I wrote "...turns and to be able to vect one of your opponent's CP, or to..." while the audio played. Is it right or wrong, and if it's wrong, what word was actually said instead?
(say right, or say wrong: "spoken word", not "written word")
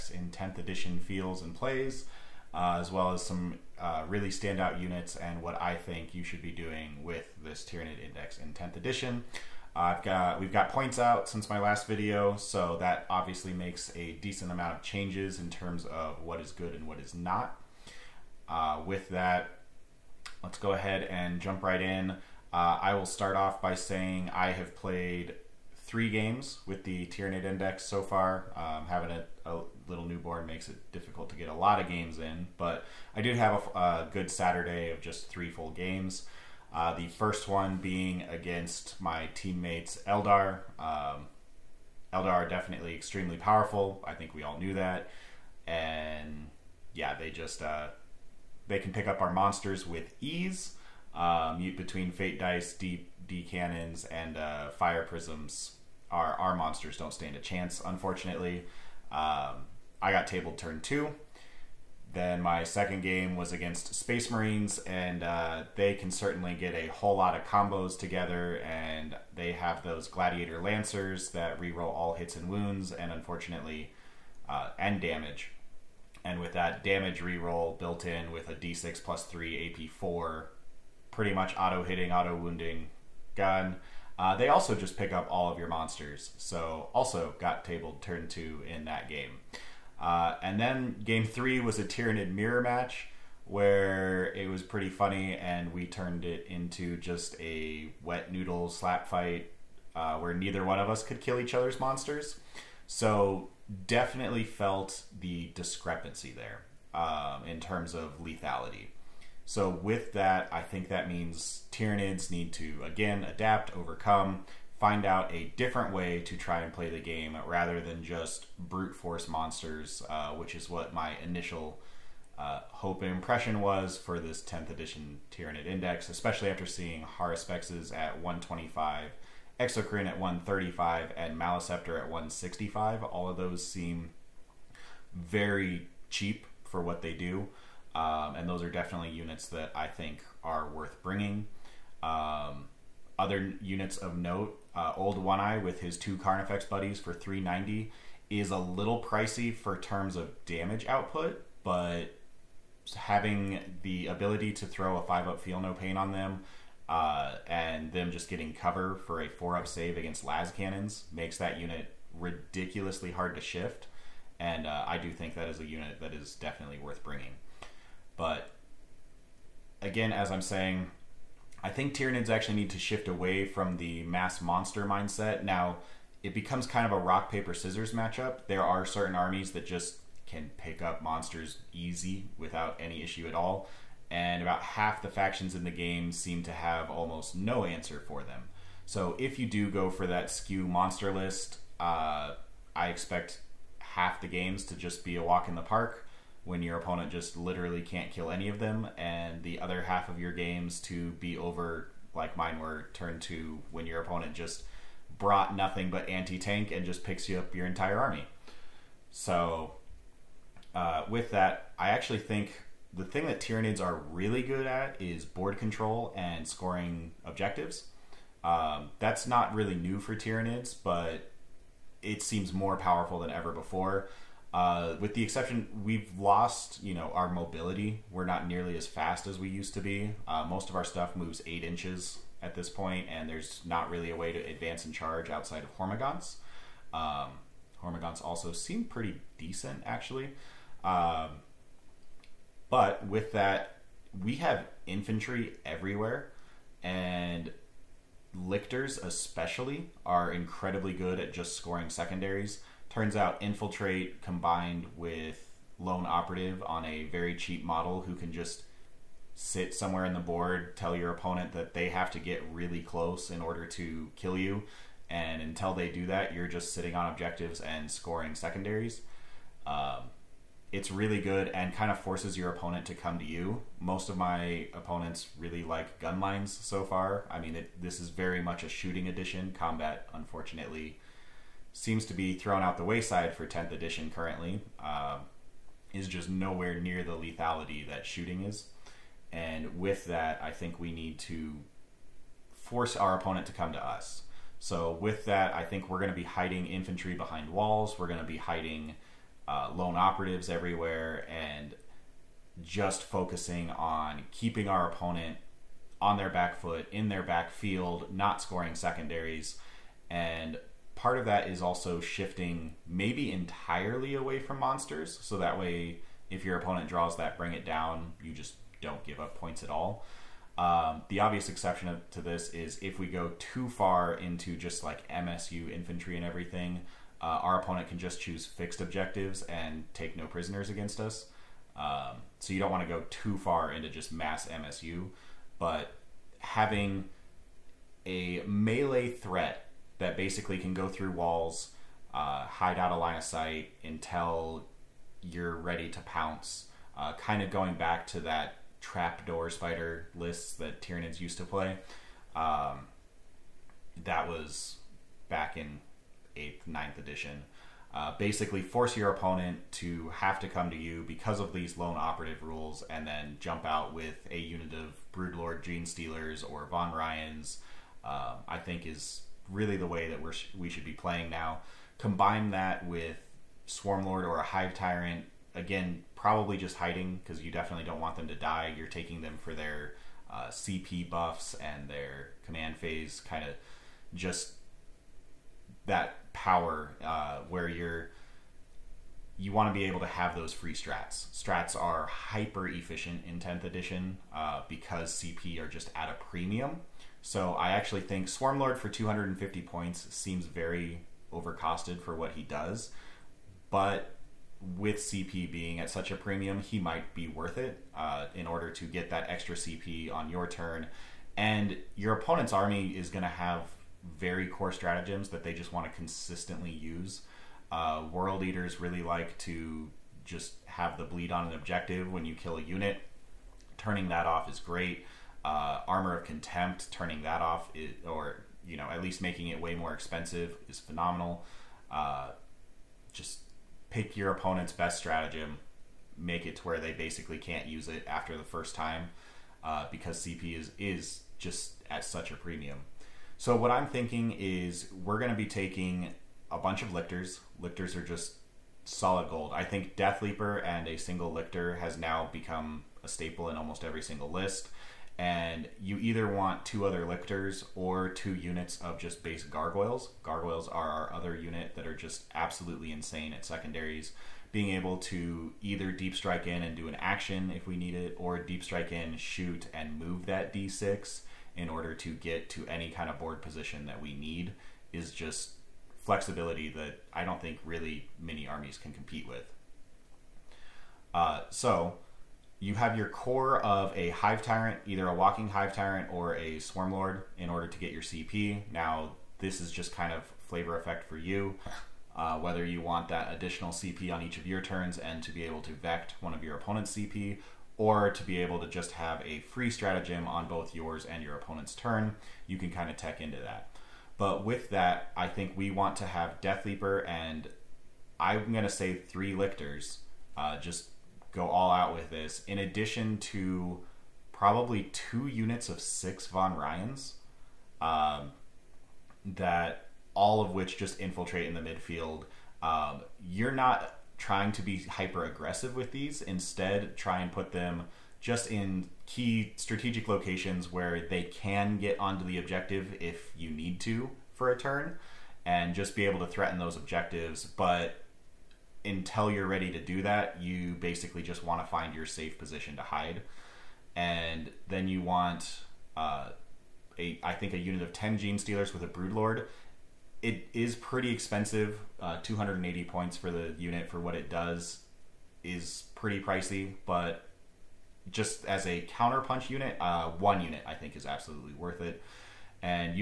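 right.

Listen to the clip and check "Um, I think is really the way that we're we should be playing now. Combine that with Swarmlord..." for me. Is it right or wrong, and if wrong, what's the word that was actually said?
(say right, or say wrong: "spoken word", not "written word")
right.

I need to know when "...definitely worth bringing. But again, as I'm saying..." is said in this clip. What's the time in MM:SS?
02:46.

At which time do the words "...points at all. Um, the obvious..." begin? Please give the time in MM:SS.
05:19.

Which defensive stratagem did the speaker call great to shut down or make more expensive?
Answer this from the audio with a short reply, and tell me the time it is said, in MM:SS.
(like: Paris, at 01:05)
Armor of Contempt, at 07:05.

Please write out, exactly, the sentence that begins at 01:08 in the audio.
And they have those Gladiator Lancers that reroll all hits and wounds, and unfortunately, uh, damage.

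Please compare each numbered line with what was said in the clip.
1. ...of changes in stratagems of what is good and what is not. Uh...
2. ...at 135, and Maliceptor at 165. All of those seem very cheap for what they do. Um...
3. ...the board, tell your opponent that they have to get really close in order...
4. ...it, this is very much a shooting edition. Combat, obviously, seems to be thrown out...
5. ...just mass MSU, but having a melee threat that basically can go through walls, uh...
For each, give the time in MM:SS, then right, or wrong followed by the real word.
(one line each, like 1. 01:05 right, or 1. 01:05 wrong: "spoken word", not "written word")
1. 00:14 wrong: "terms", not "stratagems"
2. 02:10 right
3. 04:20 right
4. 04:37 wrong: "unfortunately", not "obviously"
5. 05:33 right.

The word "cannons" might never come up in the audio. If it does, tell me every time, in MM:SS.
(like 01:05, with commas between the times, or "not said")
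00:53, 02:40.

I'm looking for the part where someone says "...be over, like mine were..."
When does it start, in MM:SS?
03:21.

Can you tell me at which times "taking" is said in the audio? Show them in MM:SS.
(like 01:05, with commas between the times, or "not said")
06:18, 07:25.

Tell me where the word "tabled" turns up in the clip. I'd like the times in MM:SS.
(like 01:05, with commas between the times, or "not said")
01:00, 01:27.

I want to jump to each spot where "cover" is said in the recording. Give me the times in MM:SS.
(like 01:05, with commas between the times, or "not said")
02:38.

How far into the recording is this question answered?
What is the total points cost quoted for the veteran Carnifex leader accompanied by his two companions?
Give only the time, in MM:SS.
02:27.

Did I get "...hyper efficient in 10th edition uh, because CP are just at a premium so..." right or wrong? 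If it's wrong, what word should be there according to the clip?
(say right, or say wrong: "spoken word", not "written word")
right.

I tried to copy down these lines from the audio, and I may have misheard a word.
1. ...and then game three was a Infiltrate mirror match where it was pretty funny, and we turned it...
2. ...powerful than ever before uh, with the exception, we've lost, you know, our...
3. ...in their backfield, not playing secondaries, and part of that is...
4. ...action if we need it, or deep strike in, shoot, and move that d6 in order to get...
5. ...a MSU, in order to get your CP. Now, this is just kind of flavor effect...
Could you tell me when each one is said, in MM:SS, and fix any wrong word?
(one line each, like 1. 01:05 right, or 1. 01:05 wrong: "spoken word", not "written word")
1. 01:30 wrong: "Tyranid", not "Infiltrate"
2. 03:42 right
3. 05:06 wrong: "scoring", not "playing"
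4. 07:46 right
5. 08:06 wrong: "Swarmlord", not "MSU".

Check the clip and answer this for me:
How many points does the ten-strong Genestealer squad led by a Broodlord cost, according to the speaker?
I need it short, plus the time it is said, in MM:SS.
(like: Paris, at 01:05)
280, at 09:12.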